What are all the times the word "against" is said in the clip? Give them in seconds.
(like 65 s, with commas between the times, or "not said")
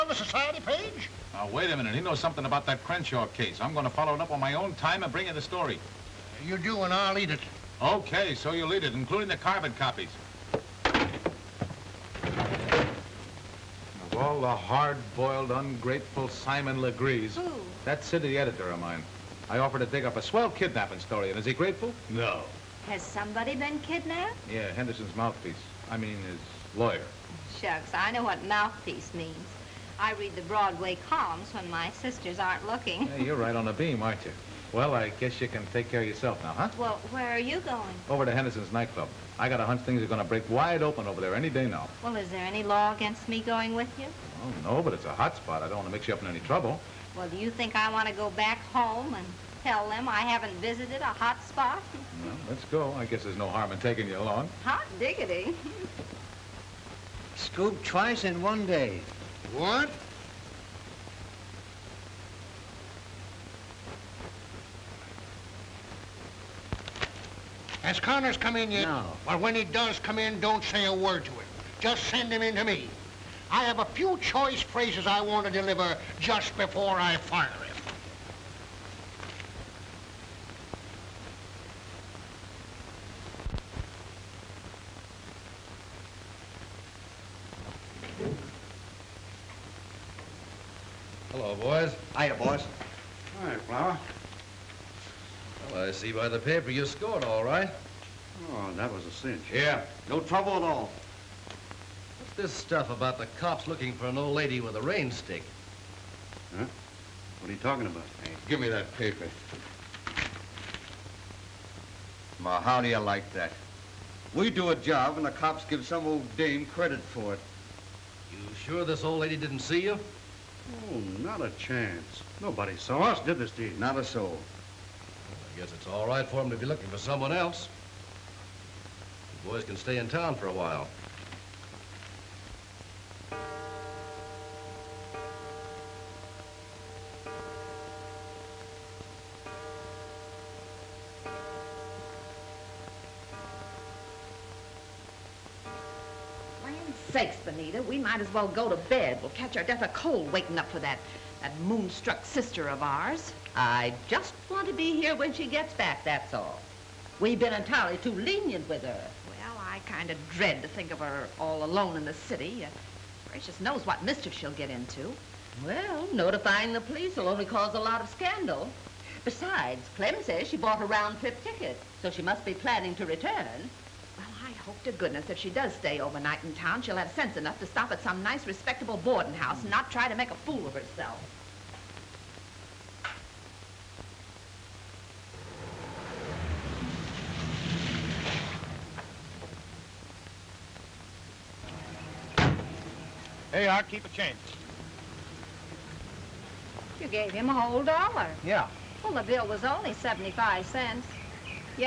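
42 s.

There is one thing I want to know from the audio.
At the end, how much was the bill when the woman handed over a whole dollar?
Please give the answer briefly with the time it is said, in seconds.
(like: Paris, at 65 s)
75 cents, at 199 s.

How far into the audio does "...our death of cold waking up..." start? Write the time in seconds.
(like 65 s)
149 s.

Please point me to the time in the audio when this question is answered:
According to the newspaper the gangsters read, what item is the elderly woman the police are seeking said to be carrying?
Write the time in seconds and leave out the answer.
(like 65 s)
104 s.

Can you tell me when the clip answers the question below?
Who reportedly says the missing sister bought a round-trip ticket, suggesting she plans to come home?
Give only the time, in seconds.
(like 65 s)
169 s.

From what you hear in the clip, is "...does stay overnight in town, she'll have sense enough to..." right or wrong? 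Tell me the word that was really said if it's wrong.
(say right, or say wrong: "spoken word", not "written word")
right.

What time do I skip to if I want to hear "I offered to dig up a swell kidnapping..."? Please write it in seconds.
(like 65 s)
19 s.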